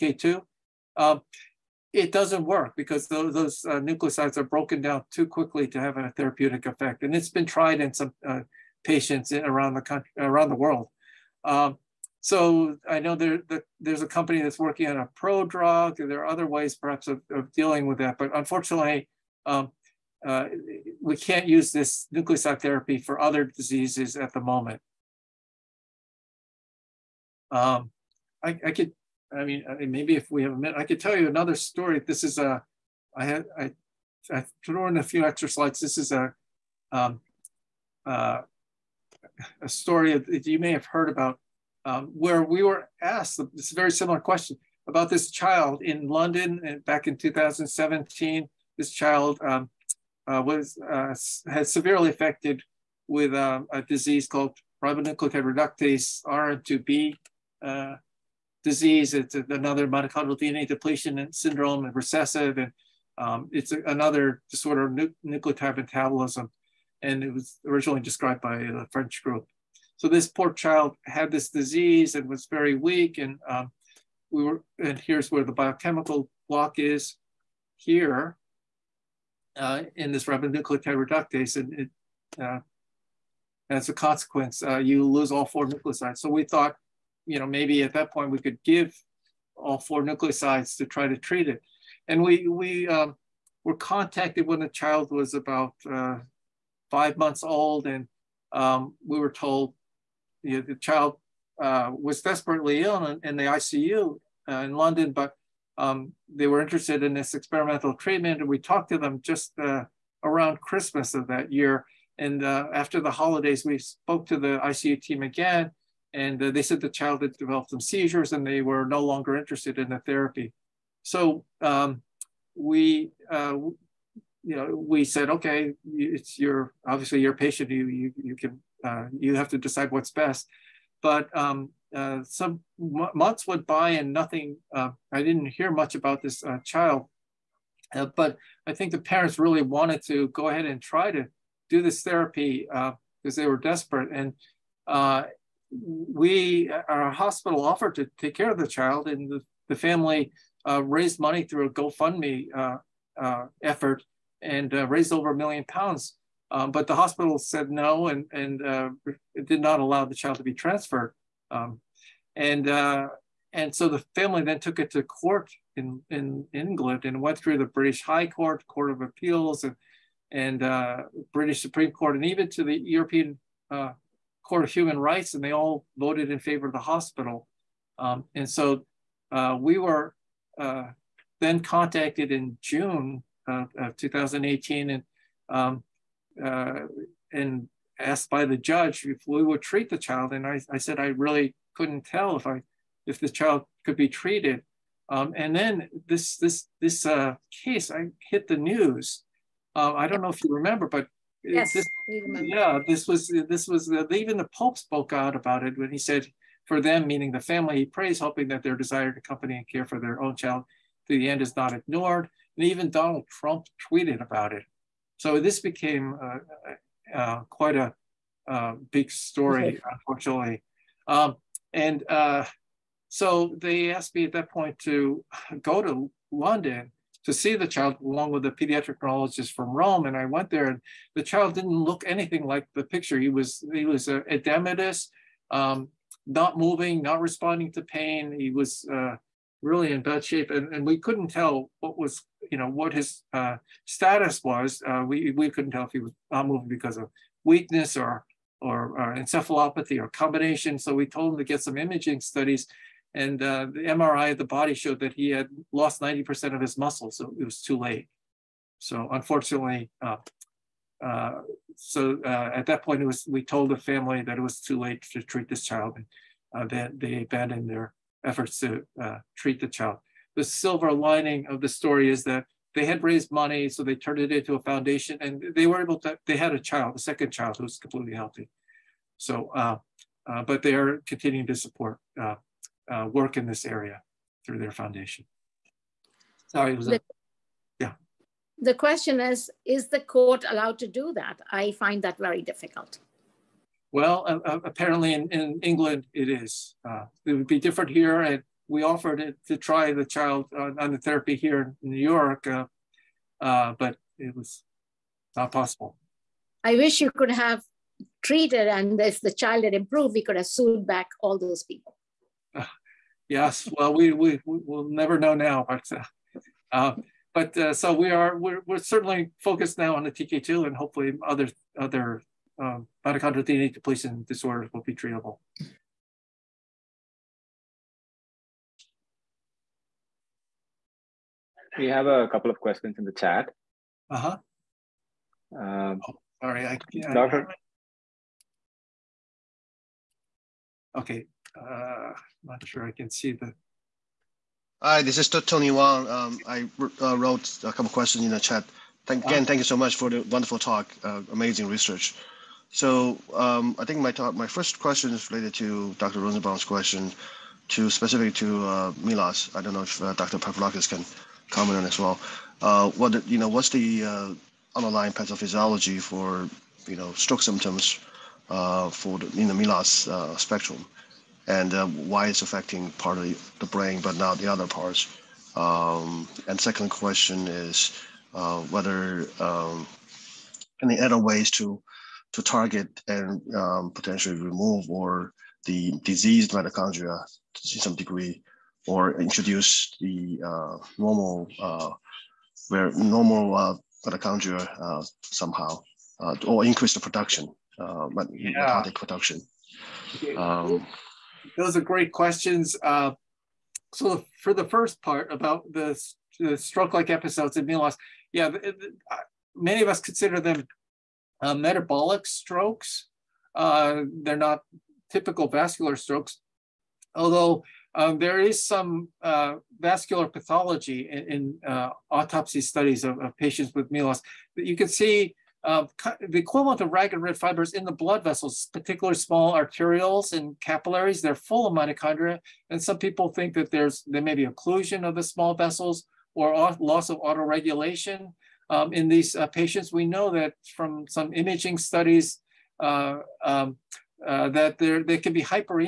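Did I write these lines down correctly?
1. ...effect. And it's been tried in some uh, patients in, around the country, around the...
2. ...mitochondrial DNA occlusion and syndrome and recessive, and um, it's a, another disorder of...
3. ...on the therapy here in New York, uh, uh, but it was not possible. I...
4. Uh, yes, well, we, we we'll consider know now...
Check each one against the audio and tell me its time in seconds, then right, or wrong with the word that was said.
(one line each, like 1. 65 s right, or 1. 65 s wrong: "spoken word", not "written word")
1. 6 s right
2. 59 s wrong: "depletion", not "occlusion"
3. 300 s right
4. 312 s wrong: "never", not "consider".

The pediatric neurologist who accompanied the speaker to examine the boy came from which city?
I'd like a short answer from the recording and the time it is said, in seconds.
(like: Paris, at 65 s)
Rome, at 229 s.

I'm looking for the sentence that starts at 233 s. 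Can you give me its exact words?
He was, he was edematous, um, not moving, not responding to pain.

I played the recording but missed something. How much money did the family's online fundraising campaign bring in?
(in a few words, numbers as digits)
over a million pounds.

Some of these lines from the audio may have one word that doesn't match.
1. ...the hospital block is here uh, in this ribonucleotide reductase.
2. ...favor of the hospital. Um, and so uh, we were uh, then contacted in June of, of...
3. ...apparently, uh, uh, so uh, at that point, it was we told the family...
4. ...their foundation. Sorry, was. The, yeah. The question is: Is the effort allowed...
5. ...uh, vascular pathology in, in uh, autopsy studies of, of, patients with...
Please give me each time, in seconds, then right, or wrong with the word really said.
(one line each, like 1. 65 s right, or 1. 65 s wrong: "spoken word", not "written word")
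1. 75 s wrong: "biochemical", not "hospital"
2. 176 s right
3. 259 s wrong: "unfortunately", not "apparently"
4. 284 s wrong: "court", not "effort"
5. 419 s right.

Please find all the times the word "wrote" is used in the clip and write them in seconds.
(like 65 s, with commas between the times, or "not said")
347 s.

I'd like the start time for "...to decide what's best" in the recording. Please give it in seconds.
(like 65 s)
129 s.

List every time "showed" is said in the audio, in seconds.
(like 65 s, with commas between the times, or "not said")
254 s.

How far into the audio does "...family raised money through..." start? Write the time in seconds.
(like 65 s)
149 s.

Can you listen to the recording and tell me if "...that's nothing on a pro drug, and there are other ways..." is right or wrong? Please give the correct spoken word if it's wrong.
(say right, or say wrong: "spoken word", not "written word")
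wrong: "working", not "nothing".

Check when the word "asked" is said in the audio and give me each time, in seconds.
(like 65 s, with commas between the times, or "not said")
43 s, 187 s, 223 s.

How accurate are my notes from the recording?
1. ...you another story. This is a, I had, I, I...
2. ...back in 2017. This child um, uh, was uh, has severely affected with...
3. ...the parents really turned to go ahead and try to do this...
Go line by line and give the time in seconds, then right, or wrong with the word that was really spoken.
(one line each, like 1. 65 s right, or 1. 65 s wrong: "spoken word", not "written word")
1. 31 s right
2. 46 s right
3. 138 s wrong: "wanted", not "turned".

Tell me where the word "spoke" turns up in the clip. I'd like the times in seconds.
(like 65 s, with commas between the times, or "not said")
113 s, 204 s.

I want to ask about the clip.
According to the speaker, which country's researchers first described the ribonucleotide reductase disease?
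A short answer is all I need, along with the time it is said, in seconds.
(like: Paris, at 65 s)
French, at 68 s.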